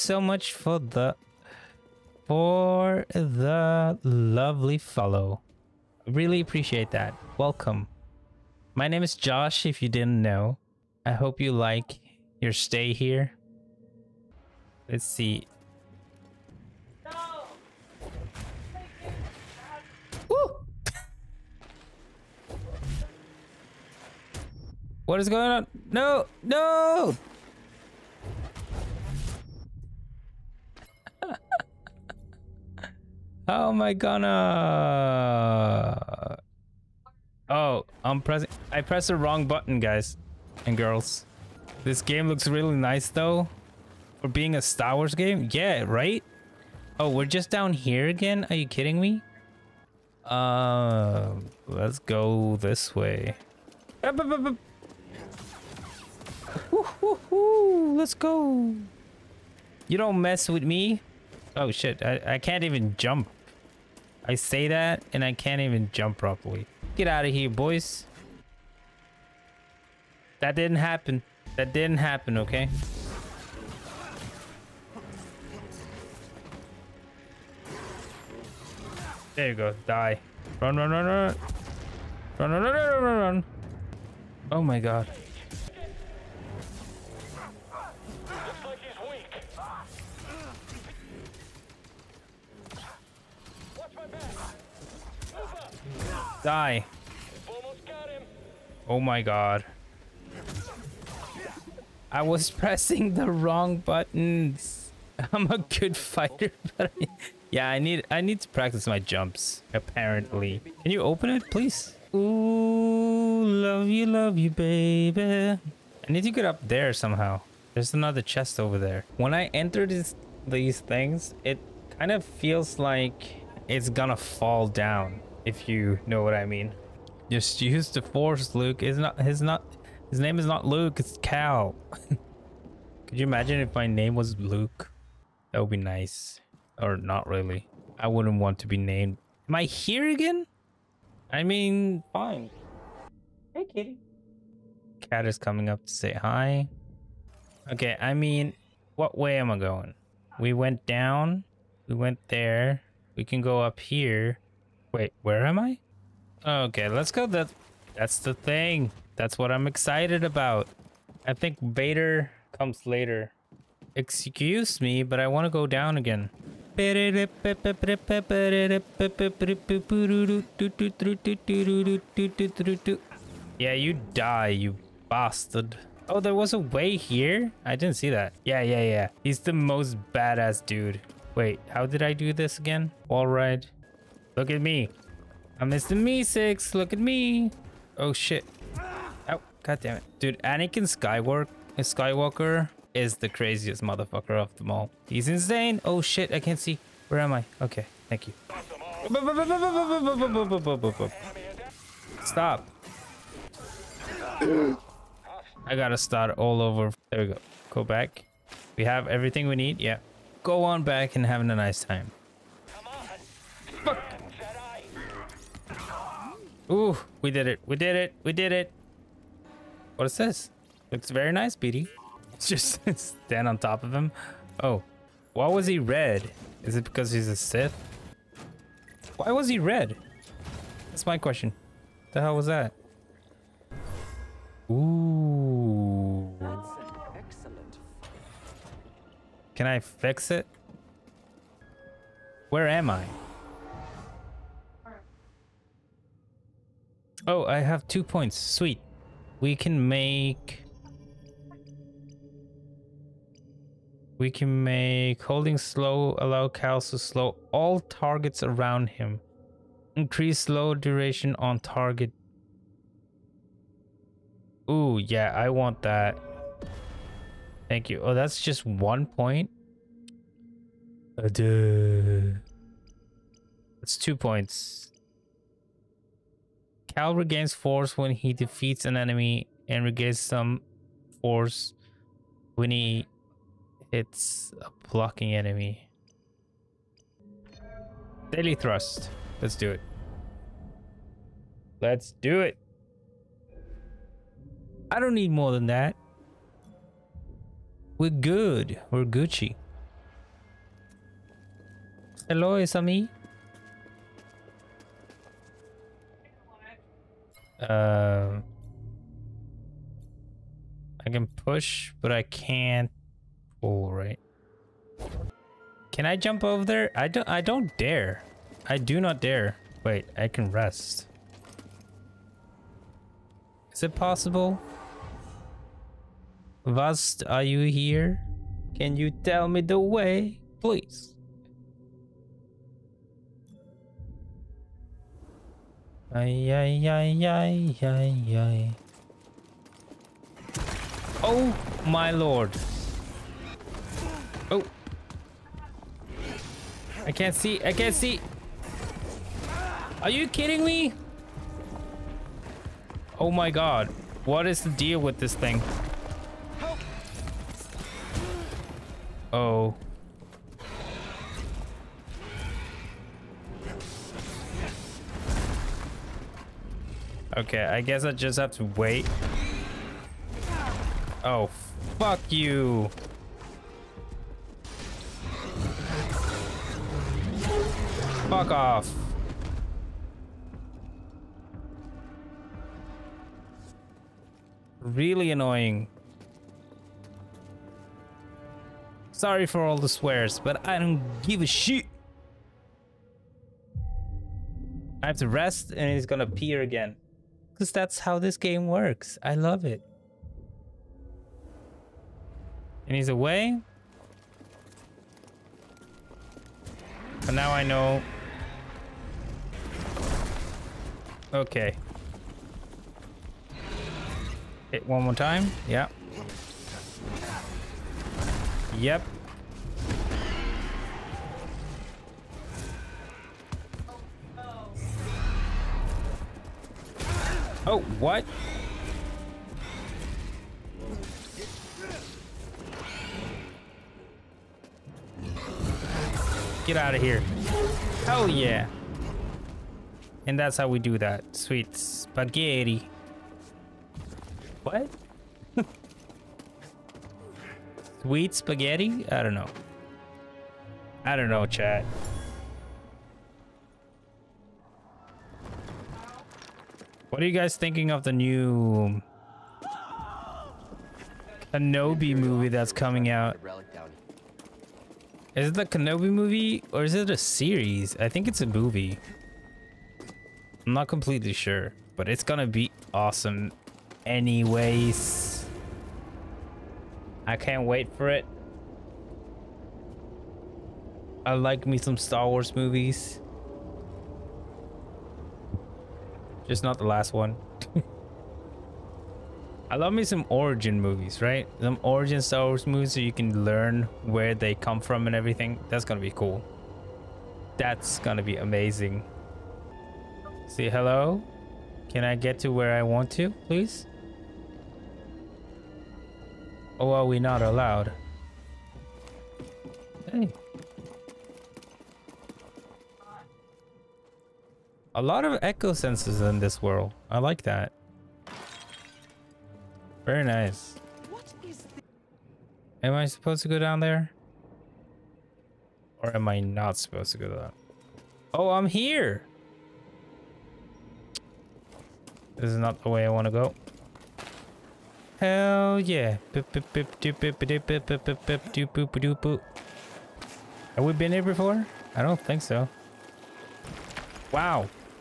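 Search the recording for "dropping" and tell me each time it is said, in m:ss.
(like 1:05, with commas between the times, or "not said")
not said.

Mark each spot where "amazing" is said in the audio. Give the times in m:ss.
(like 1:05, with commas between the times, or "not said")
8:18.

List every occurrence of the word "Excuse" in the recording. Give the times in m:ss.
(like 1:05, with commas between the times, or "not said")
2:43.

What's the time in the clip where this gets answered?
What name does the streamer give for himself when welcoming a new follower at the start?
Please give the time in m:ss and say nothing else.
0:09.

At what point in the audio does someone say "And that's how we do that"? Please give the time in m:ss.
7:20.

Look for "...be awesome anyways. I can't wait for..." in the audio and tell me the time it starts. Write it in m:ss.
7:52.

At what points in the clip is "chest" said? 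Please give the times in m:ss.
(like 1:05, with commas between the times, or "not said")
1:58.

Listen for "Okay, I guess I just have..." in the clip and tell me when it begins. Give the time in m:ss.
6:07.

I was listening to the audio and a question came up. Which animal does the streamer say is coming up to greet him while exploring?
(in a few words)
Cat.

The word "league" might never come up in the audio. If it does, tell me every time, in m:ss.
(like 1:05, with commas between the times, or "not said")
not said.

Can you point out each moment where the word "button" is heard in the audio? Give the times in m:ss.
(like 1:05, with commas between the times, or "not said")
0:39, 1:43.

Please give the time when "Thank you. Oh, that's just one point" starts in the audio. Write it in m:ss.
4:27.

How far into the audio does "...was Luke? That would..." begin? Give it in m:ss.
2:14.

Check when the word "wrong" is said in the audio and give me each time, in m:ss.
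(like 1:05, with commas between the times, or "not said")
0:39, 1:43.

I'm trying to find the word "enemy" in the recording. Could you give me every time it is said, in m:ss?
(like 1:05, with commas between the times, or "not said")
4:38, 4:45.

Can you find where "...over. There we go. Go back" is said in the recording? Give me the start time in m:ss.
3:26.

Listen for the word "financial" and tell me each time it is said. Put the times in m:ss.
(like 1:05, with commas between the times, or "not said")
not said.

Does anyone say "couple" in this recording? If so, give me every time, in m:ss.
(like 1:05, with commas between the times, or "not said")
not said.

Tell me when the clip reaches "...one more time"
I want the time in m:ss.
6:54.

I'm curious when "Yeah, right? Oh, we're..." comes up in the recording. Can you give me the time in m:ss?
0:45.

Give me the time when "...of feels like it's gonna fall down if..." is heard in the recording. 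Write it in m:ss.
2:02.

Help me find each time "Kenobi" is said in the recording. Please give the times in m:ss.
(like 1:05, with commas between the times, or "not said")
7:41, 7:45.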